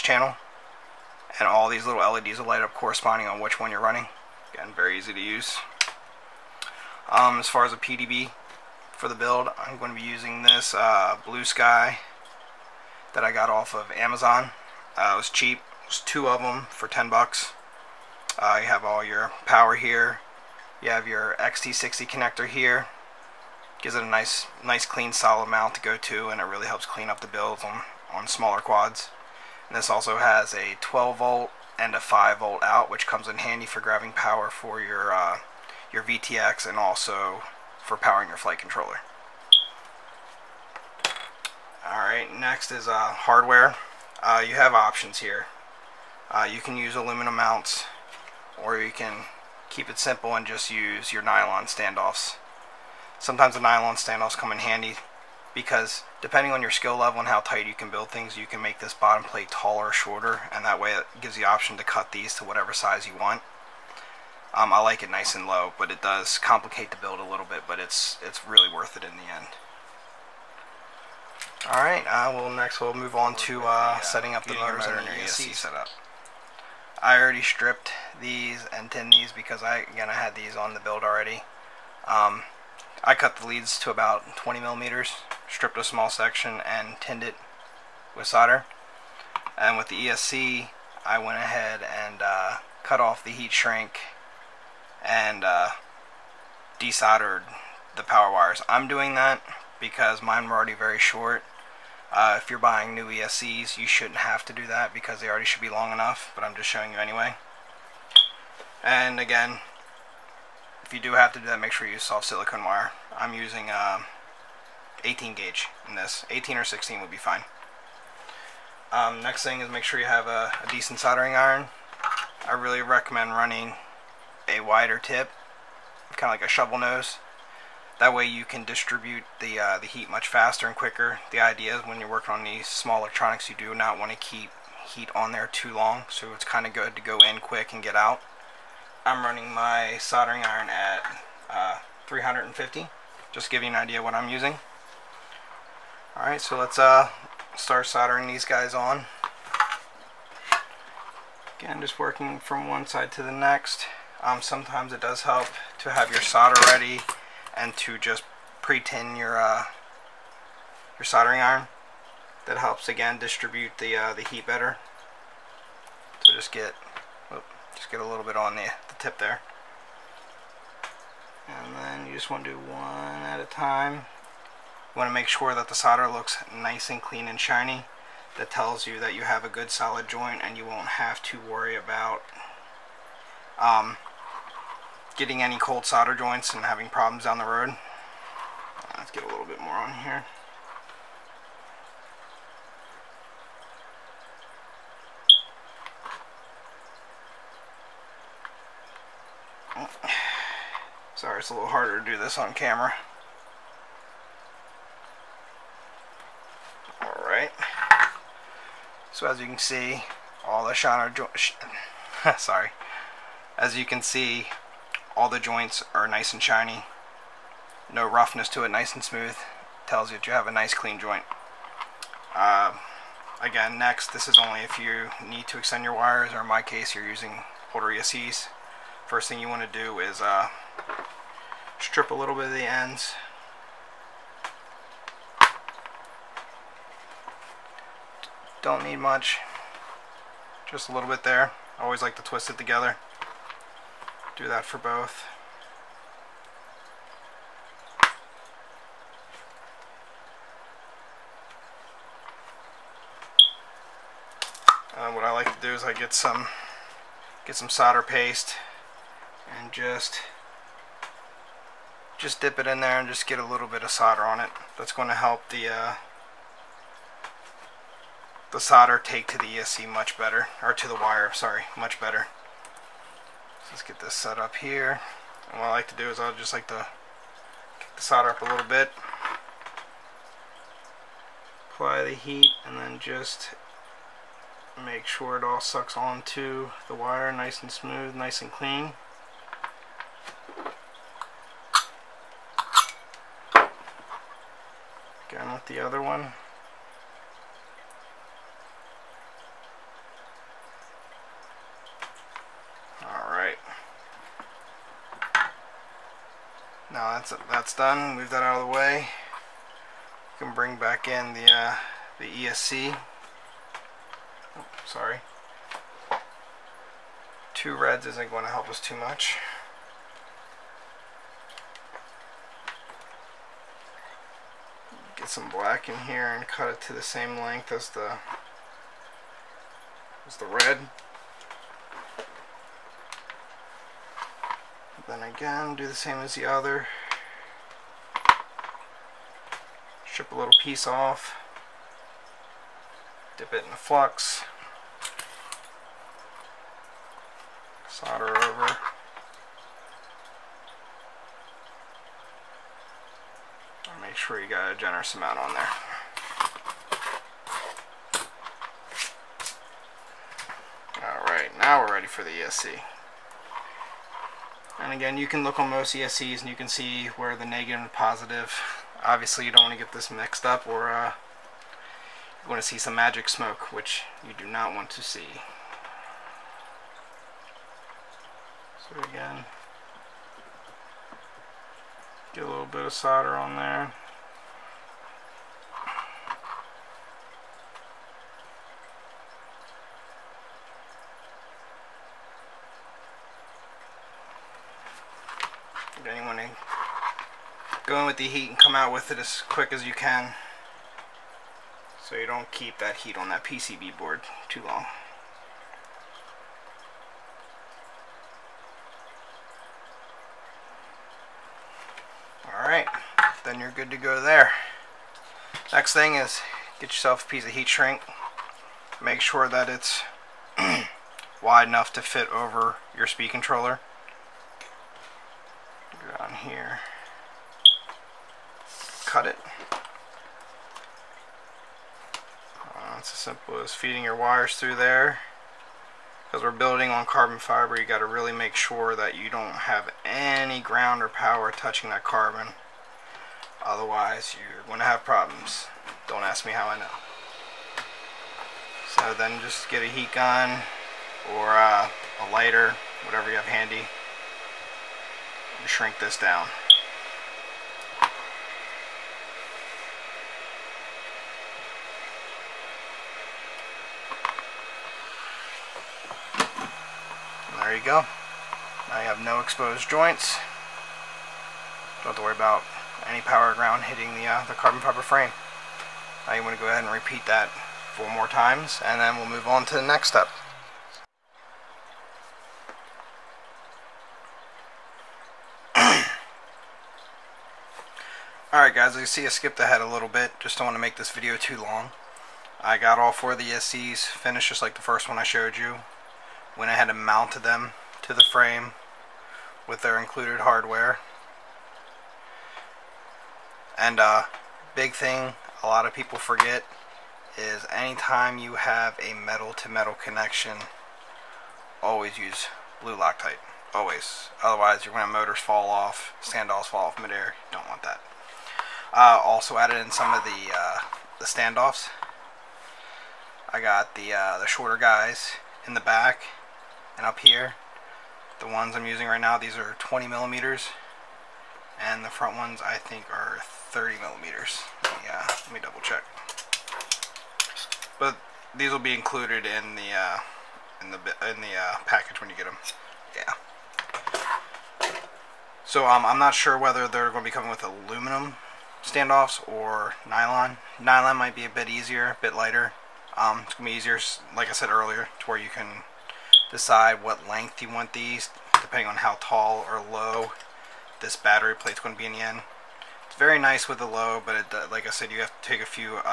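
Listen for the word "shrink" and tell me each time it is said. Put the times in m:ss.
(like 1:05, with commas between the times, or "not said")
1:33, 6:57, 7:35.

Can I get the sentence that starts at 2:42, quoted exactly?
That helps again distribute the uh, the heat better.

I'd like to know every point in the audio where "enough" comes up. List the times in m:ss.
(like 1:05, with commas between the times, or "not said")
1:45, 7:01.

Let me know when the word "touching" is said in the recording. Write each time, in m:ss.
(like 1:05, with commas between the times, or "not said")
7:21.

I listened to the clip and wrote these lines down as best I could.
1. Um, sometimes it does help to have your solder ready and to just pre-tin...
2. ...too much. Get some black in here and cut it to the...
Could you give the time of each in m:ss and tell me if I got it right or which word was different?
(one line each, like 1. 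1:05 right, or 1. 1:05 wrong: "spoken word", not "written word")
1. 2:34 right
2. 5:18 right.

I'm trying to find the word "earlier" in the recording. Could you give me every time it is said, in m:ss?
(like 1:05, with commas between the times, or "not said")
9:14.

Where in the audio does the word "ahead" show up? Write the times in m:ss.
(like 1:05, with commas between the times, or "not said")
1:31, 7:56, 8:09, 8:16.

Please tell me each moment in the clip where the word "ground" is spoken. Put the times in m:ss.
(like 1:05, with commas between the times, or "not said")
7:20, 7:53.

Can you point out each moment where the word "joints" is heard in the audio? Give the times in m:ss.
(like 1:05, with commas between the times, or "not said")
3:00, 3:06, 3:31, 3:35, 3:40, 7:49.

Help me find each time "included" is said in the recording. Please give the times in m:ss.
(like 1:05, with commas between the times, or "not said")
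8:19, 8:58.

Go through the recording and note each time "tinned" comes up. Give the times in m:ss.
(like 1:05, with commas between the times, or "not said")
1:18, 1:26.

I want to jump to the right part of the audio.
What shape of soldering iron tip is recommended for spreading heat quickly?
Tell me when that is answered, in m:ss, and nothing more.
2:06.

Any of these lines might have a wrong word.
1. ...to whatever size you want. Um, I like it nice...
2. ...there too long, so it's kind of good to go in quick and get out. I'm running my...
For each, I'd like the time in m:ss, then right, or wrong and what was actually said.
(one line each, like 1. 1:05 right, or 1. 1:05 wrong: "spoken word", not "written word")
1. 1:02 right
2. 2:15 right.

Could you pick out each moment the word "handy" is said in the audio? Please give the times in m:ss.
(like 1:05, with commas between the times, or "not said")
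0:33, 0:54, 7:33.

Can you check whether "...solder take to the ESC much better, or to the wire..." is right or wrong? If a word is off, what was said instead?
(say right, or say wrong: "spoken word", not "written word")
right.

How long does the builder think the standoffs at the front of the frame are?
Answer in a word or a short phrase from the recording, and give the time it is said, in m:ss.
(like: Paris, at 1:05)
30 millimeters, at 8:53.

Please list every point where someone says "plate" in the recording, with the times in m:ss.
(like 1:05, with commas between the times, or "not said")
0:59, 9:21.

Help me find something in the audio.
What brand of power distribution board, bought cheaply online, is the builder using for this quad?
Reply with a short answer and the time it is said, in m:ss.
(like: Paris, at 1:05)
Blue Sky, at 0:11.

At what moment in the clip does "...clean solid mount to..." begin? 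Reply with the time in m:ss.
0:24.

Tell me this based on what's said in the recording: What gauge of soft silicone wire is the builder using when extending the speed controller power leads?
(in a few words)
18 gauge.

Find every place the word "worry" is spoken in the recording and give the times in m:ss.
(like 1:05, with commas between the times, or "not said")
3:01, 7:52.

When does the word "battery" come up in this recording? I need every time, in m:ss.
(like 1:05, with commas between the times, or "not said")
9:21.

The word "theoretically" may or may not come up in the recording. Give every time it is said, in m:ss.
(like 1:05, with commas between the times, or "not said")
not said.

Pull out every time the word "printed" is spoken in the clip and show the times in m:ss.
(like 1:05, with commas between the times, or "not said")
not said.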